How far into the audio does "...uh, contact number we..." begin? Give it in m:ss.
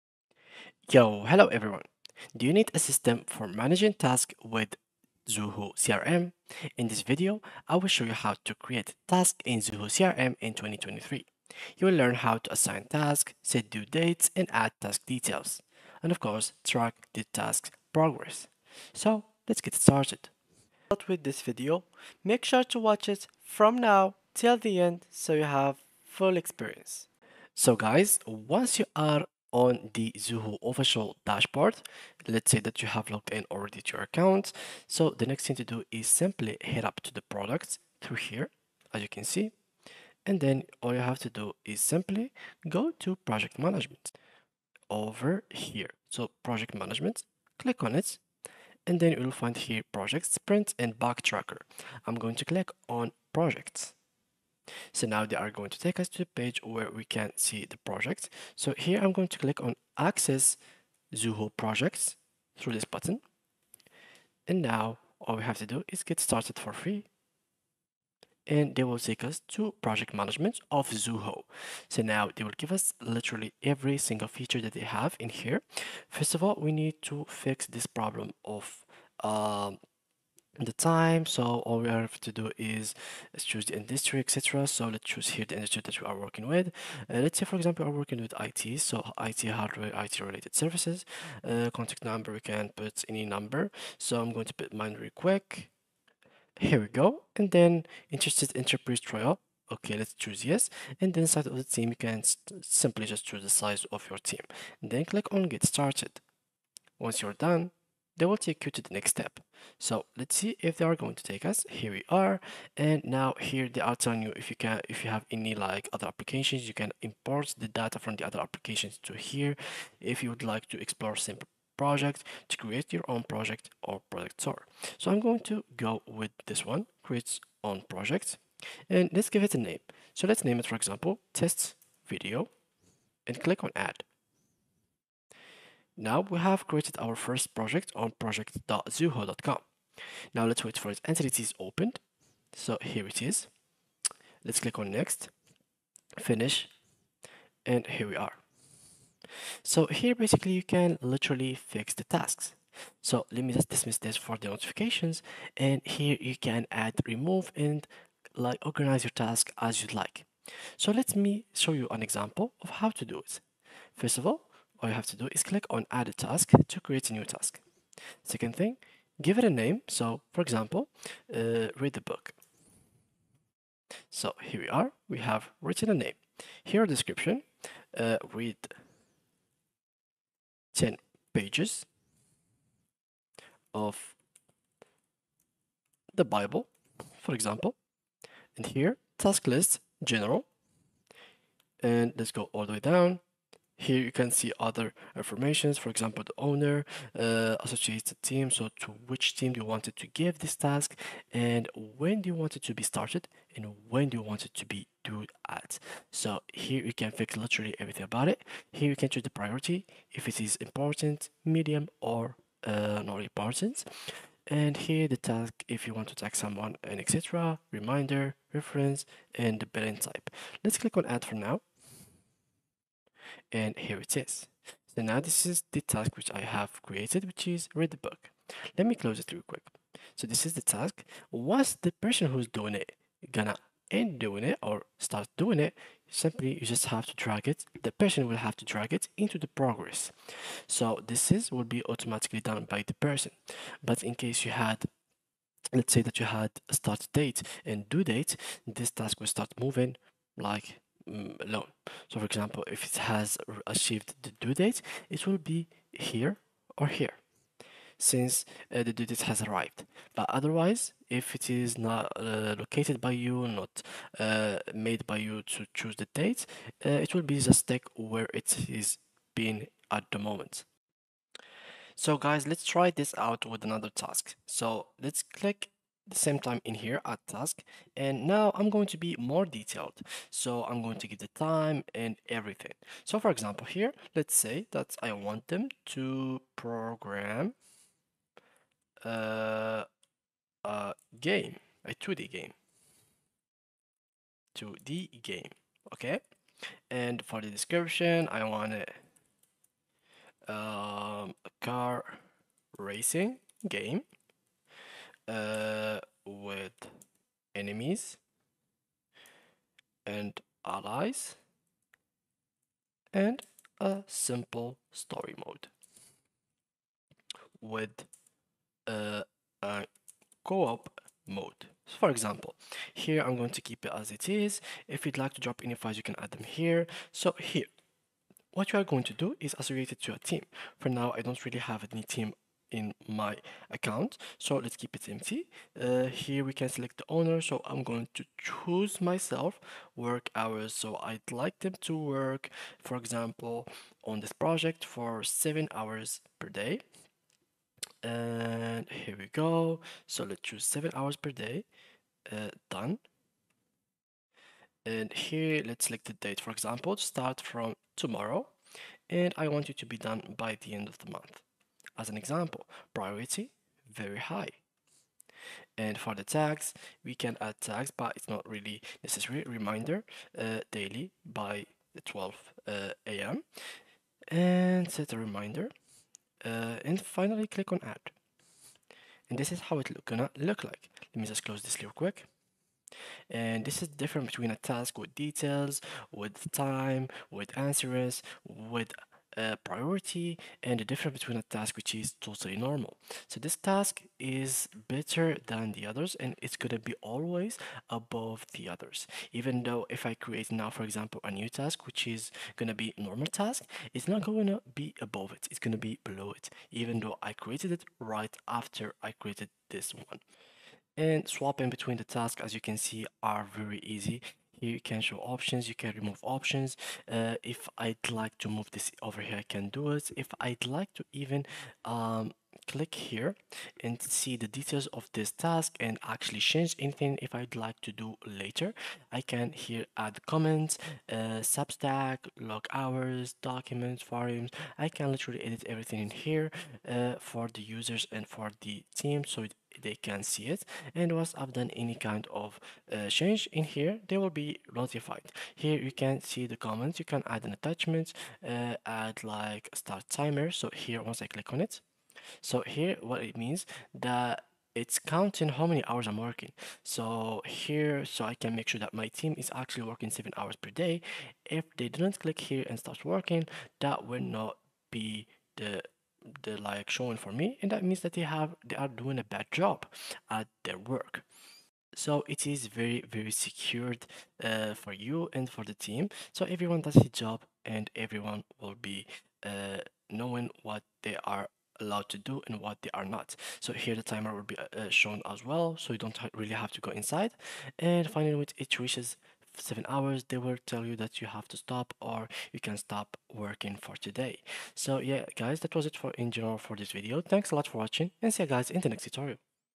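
1:31.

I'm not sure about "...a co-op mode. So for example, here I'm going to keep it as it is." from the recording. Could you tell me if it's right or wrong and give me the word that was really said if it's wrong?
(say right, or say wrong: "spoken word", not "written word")
right.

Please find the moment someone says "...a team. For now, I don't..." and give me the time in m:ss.
5:30.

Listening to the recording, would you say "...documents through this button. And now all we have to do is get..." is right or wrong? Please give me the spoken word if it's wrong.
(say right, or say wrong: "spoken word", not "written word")
wrong: "projects", not "documents".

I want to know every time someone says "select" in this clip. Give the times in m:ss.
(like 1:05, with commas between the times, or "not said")
5:36, 5:55.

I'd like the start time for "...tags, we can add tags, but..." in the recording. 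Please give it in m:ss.
6:06.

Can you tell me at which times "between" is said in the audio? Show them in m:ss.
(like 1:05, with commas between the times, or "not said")
6:24, 6:31, 6:51.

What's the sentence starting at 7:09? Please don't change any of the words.
I can here add comments, uh, subtask, log hours, documents, forums.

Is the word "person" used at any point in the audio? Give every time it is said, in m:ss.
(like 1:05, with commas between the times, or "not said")
3:52, 3:57, 4:02.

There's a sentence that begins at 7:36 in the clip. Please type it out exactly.
So here, so I can make sure that my team is actually working seven hours per day.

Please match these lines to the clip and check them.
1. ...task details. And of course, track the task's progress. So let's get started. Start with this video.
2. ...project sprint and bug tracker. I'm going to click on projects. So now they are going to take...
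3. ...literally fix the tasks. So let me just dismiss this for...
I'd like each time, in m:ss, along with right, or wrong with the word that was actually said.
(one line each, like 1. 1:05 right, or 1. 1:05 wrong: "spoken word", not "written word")
1. 0:14 right
2. 0:49 right
3. 2:31 right.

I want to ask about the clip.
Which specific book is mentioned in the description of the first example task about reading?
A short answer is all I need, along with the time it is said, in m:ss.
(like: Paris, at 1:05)
The Bible, at 3:06.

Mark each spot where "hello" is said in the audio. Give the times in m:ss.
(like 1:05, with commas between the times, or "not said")
0:01.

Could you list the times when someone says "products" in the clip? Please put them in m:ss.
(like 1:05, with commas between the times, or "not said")
0:37.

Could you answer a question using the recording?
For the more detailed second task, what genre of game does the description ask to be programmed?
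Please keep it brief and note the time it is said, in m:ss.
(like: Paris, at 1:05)
car racing game, at 5:01.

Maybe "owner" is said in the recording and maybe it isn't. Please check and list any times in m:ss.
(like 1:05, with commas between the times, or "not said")
3:16, 5:37.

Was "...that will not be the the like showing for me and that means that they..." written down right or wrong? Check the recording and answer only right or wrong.
right.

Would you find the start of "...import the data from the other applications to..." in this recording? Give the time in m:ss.
1:57.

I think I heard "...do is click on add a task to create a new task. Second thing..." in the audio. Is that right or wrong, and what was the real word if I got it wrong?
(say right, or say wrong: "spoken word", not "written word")
right.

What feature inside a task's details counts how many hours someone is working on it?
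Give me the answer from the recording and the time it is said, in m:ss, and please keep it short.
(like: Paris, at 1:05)
start timer, at 7:29.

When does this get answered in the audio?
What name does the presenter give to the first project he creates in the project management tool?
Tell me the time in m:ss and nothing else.
2:11.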